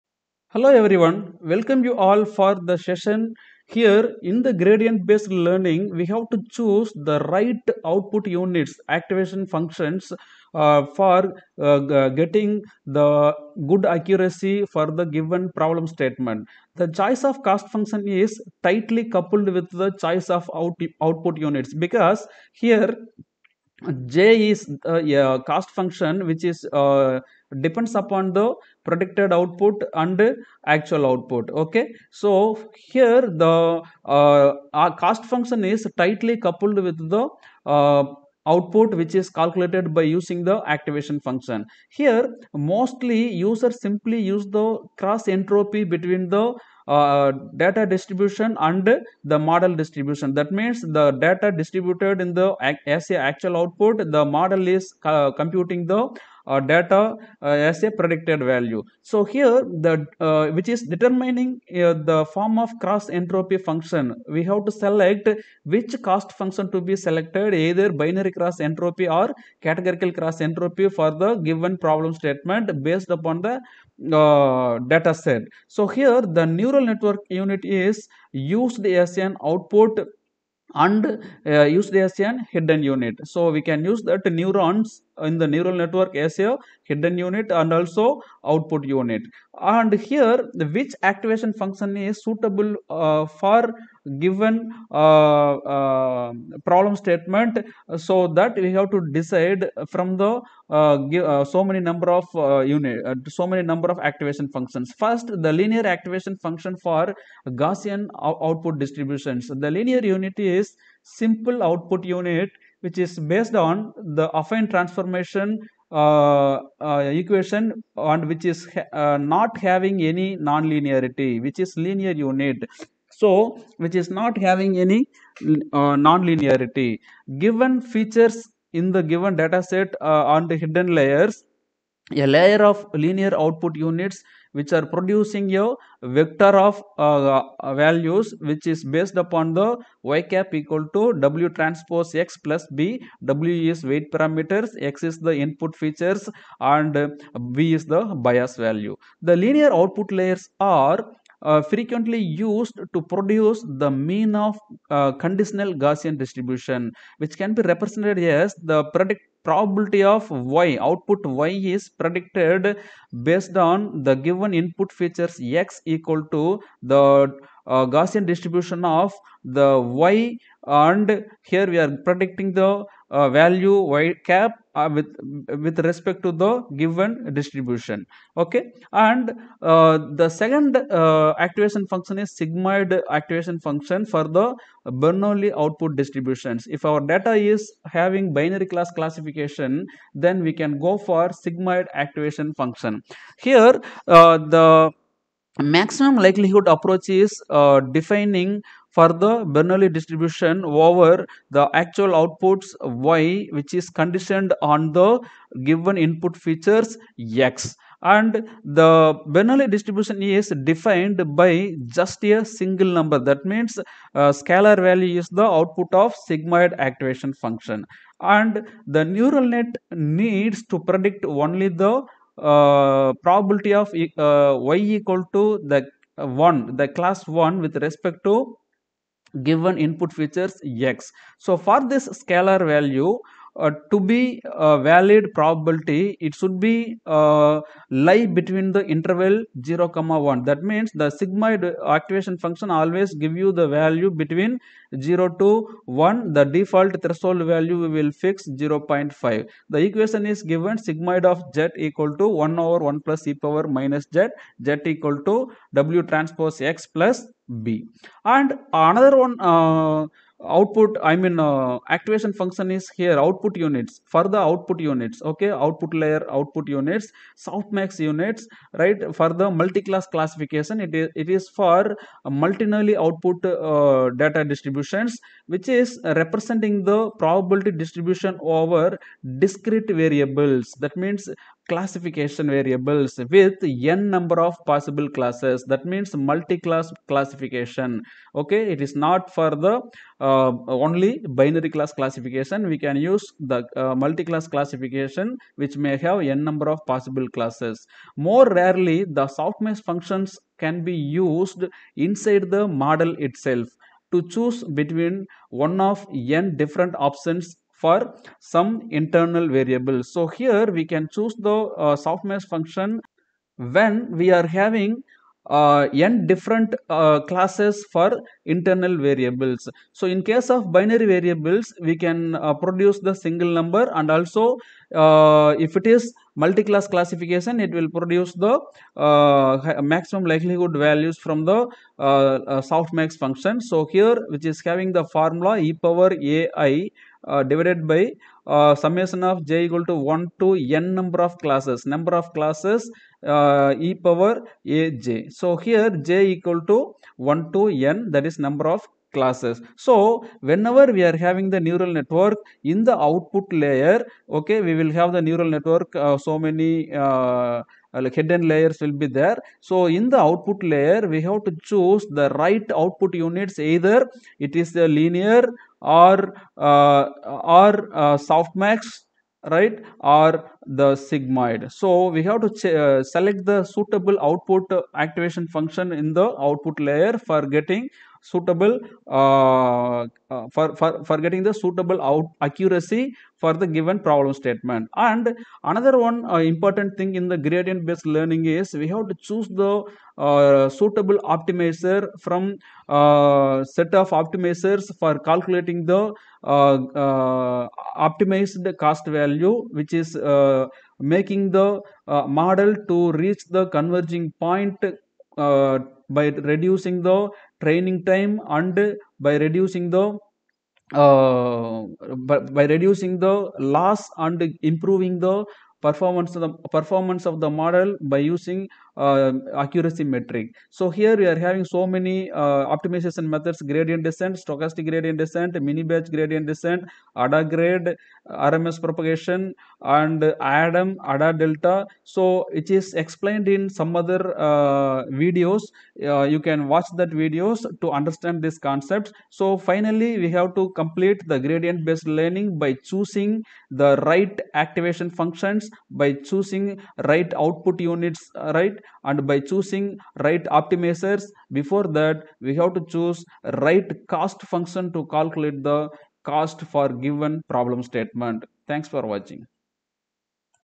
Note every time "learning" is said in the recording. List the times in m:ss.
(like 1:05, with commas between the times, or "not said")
0:05, 6:28, 7:22.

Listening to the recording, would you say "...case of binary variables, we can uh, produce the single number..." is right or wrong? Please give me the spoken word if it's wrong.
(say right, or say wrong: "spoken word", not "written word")
right.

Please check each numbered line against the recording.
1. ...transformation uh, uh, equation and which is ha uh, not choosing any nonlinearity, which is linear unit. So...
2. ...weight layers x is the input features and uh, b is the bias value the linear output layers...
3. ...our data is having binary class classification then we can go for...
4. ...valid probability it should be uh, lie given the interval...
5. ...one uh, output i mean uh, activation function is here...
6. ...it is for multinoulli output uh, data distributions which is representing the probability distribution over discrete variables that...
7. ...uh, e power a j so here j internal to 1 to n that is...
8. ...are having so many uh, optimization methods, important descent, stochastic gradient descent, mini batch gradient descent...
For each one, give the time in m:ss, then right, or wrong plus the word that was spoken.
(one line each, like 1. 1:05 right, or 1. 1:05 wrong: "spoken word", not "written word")
1. 1:54 wrong: "having", not "choosing"
2. 2:23 wrong: "parameters", not "layers"
3. 3:06 right
4. 3:54 wrong: "between", not "given"
5. 4:19 right
6. 4:31 right
7. 5:43 wrong: "equal", not "internal"
8. 7:01 wrong: "gradient", not "important".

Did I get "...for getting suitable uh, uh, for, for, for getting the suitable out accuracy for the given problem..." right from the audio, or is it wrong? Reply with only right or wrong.
right.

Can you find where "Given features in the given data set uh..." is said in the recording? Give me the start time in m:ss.
2:07.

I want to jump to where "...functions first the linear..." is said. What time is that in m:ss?
1:44.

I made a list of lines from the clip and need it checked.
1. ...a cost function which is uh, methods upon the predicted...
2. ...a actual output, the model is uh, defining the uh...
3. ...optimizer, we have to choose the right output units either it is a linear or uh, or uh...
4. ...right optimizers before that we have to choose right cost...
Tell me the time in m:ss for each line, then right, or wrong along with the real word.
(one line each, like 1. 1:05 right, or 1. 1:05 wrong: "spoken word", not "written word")
1. 0:24 wrong: "depends", not "methods"
2. 0:53 wrong: "computing", not "defining"
3. 6:00 wrong: "layer", not "optimizer"
4. 7:30 right.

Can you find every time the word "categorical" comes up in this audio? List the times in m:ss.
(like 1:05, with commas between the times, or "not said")
1:09.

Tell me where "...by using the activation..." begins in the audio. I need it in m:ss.
0:39.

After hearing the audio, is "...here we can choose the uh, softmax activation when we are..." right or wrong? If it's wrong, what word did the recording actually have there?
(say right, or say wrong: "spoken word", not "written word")
wrong: "function", not "activation".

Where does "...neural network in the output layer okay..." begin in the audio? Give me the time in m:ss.
5:51.